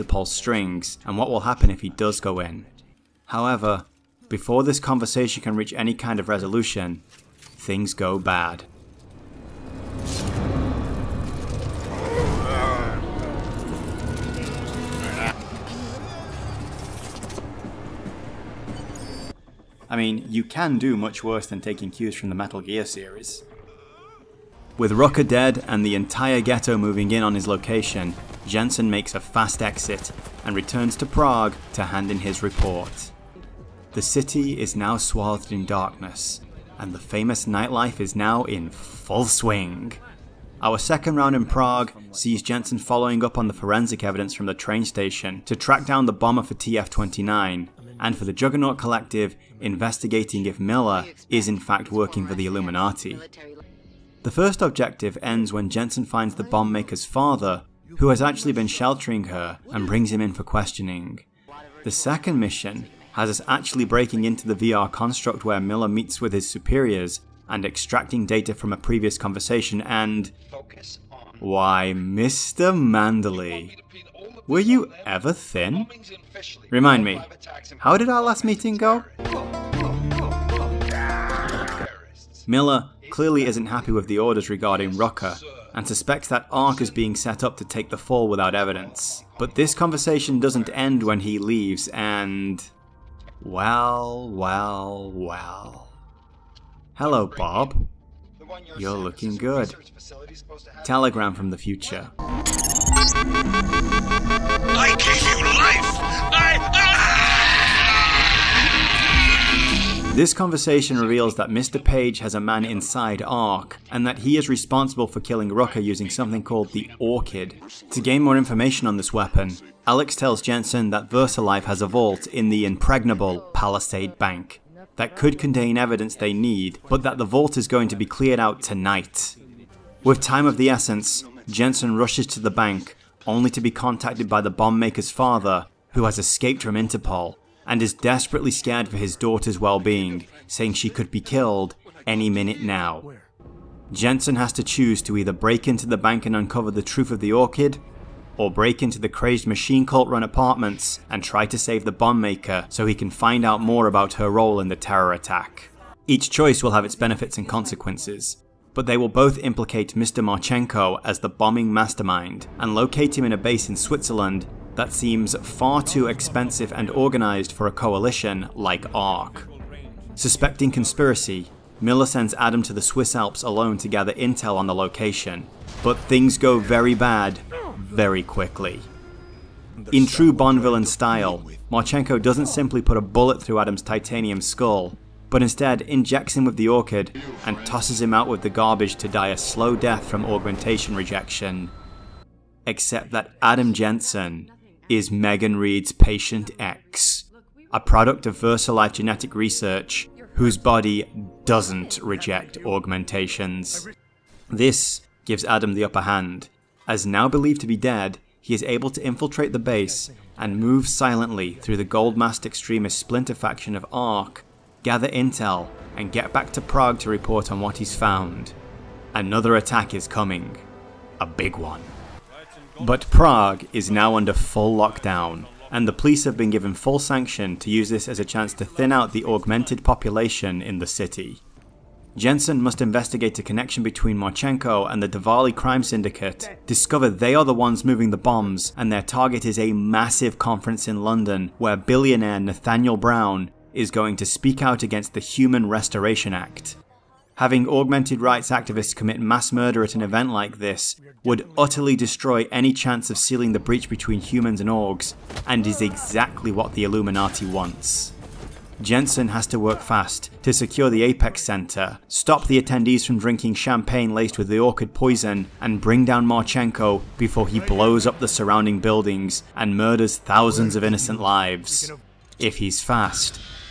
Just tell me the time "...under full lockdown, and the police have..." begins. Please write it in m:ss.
3:44.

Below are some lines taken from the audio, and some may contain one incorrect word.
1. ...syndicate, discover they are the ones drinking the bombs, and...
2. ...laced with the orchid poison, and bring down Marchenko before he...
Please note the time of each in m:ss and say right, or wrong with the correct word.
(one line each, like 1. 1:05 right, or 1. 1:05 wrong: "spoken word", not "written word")
1. 3:55 wrong: "moving", not "drinking"
2. 4:24 right.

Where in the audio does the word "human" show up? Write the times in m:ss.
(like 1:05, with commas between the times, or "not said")
4:05, 4:14.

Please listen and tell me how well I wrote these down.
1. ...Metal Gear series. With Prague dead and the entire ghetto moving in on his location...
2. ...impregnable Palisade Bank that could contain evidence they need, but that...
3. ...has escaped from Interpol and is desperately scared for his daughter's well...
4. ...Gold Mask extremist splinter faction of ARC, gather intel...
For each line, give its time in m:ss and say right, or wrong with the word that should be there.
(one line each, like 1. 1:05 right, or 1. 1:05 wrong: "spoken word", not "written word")
1. 0:22 wrong: "Rucker", not "Prague"
2. 2:02 right
3. 2:16 right
4. 3:31 right.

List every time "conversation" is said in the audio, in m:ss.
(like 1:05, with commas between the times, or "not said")
0:04, 1:09, 1:29, 1:50.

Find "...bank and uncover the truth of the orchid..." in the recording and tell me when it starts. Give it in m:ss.
2:25.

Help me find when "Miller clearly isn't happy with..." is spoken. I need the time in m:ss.
1:22.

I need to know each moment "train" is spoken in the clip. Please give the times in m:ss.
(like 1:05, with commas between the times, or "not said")
0:44.